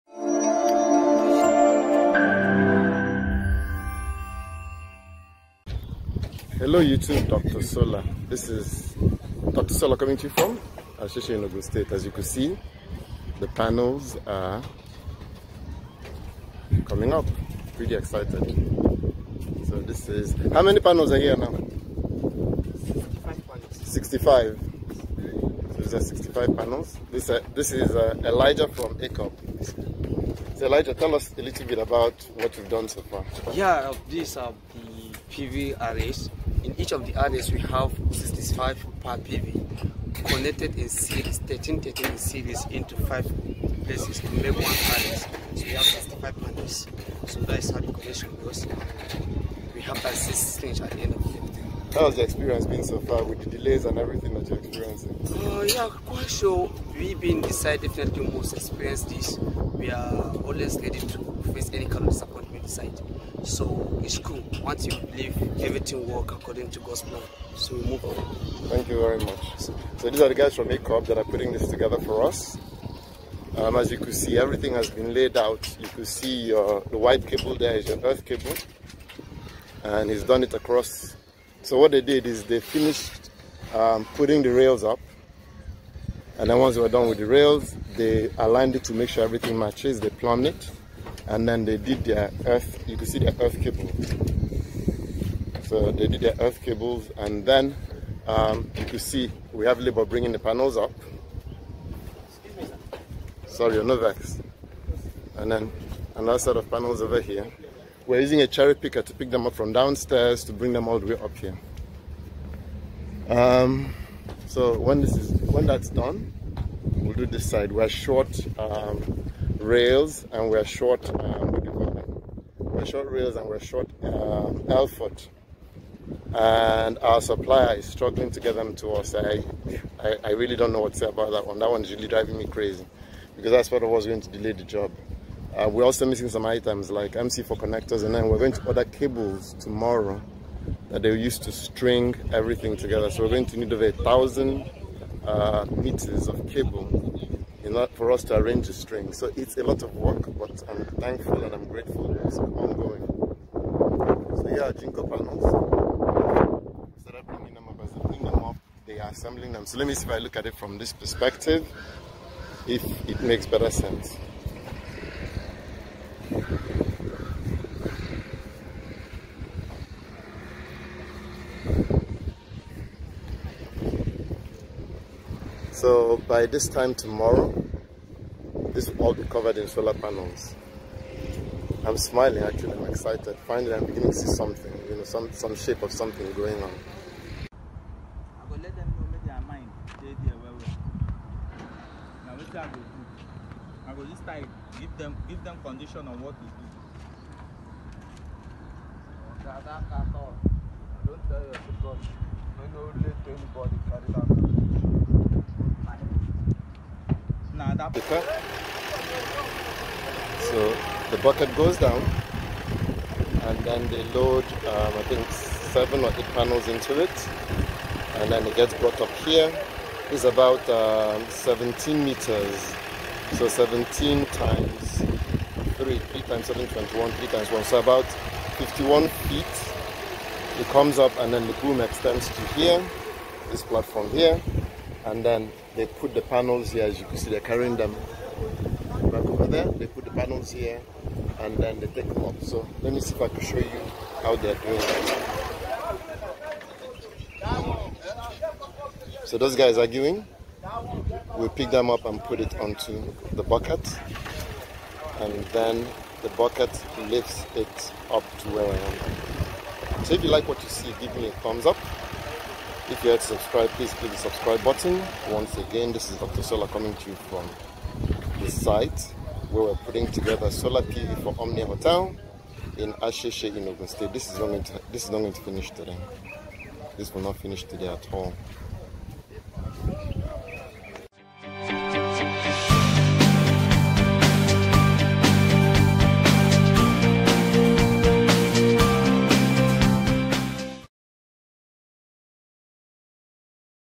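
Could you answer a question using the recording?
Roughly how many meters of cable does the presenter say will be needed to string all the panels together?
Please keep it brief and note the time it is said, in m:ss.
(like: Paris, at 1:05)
over 1000 meters, at 2:23.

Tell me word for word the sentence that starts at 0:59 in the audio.
We are always ready to face any kind of disappointment we side.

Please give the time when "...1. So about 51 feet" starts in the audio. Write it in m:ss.
3:47.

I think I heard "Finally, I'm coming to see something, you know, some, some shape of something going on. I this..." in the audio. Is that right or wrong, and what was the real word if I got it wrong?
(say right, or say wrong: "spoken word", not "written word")
wrong: "beginning", not "coming".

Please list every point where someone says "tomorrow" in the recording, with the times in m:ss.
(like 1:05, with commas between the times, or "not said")
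2:19, 2:56.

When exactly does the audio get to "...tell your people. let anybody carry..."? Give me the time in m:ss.
3:21.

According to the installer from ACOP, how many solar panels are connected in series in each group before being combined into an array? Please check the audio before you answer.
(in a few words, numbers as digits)
13.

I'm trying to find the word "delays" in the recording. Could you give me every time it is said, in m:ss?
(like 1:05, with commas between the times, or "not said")
0:53, 2:14.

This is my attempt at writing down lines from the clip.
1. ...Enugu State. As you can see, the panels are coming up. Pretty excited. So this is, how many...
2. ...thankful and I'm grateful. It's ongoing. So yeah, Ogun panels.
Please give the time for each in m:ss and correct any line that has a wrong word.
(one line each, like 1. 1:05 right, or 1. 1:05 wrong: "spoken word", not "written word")
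1. 0:11 right
2. 2:30 wrong: "Jinko", not "Ogun".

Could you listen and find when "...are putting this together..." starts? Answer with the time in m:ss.
1:11.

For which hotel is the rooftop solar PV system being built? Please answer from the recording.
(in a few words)
Omnia Hotel.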